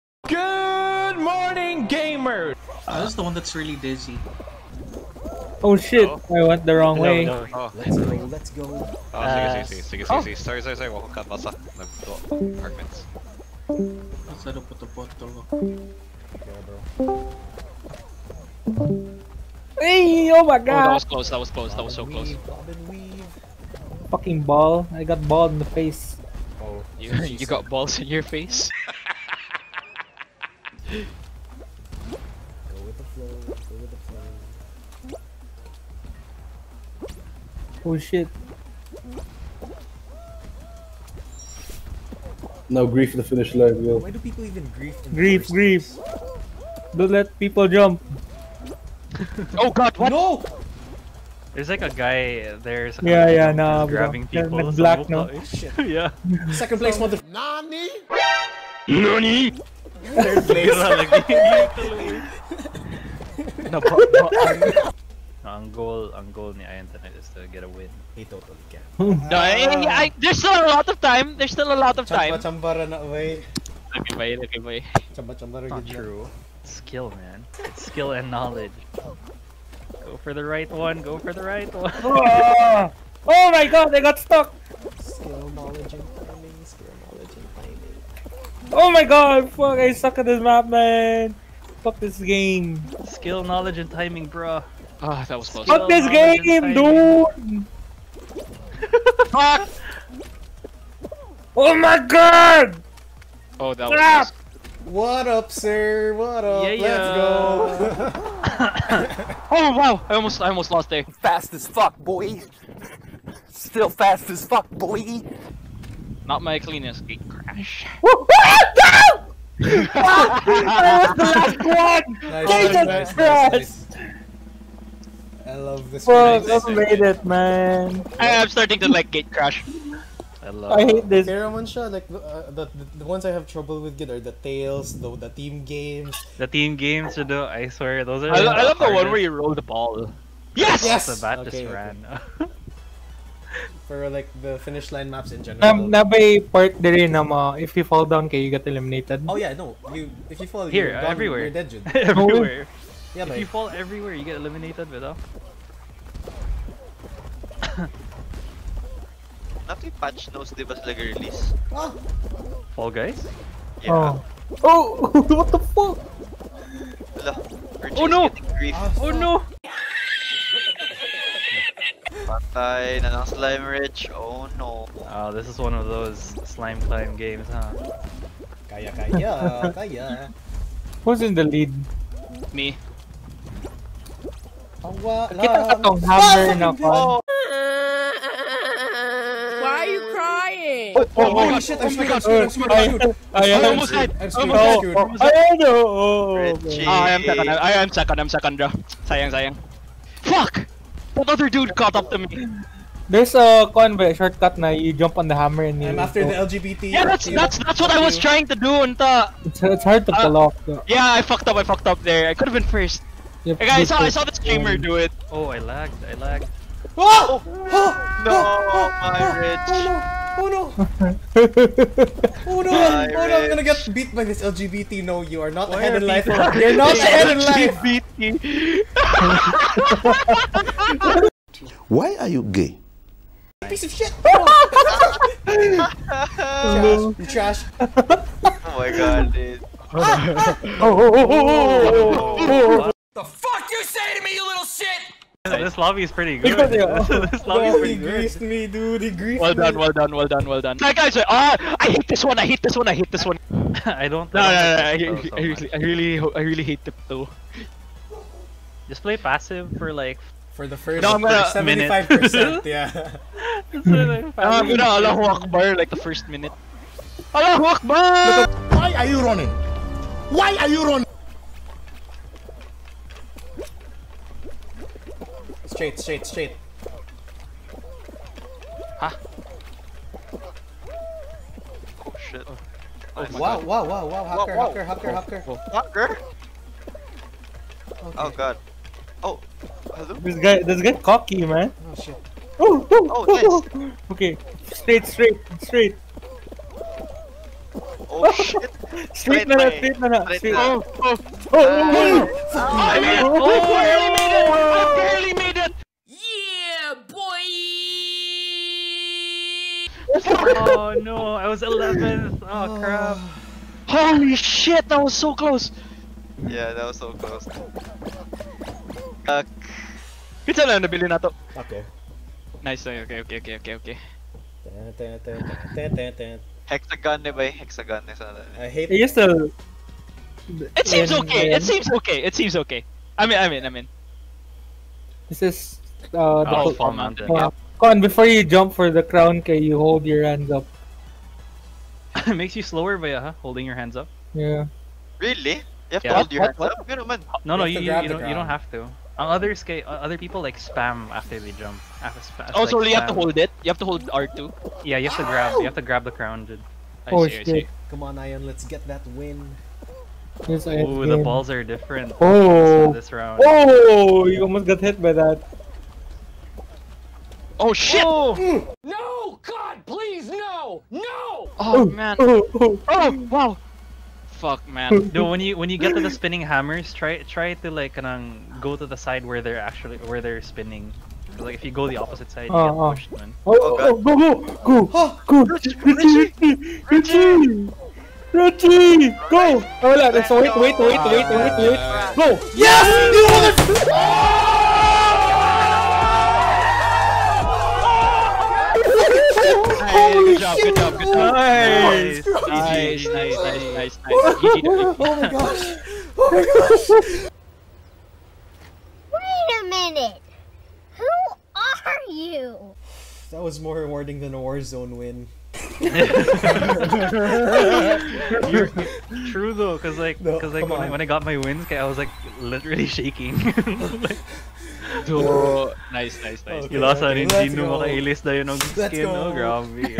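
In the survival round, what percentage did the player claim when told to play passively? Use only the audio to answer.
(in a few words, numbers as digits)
75%.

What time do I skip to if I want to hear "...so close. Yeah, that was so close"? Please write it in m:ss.
5:15.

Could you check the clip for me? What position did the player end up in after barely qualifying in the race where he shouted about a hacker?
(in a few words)
11th.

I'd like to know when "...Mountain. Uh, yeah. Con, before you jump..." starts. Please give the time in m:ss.
5:36.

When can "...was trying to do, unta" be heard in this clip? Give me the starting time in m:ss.
3:28.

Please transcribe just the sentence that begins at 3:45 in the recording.
No, you are not Why ahead in life.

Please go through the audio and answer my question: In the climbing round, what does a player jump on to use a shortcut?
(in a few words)
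The hammer.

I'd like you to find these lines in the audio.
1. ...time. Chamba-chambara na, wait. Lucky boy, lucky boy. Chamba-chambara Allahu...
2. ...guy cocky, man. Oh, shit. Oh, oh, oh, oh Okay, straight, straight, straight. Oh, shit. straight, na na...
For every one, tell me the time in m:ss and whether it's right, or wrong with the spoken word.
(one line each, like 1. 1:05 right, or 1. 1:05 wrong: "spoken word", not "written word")
1. 1:12 wrong: "Not", not "Allahu"
2. 4:50 right.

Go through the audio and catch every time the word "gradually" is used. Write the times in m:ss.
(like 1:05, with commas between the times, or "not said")
not said.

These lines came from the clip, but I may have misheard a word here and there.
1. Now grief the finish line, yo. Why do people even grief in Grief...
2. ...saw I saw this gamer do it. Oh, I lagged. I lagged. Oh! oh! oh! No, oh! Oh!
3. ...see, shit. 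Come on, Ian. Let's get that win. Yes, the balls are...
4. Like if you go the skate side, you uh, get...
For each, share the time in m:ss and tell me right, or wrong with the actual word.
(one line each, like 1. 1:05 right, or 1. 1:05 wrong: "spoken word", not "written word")
1. 0:42 right
2. 3:34 right
3. 5:57 right
4. 6:21 wrong: "opposite", not "skate".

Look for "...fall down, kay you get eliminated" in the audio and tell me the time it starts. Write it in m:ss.
2:27.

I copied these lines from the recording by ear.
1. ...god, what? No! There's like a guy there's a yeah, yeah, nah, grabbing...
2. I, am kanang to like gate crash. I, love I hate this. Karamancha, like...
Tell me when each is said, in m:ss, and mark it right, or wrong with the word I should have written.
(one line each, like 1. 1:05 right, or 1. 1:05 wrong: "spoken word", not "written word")
1. 0:49 right
2. 2:08 wrong: "starting", not "kanang".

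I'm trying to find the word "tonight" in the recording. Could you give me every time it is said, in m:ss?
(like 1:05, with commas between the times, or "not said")
1:06.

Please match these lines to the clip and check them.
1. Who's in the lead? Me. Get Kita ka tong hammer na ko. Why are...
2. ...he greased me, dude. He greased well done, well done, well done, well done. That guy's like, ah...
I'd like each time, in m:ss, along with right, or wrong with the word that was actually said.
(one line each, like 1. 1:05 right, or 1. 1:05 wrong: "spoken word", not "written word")
1. 3:01 right
2. 4:07 right.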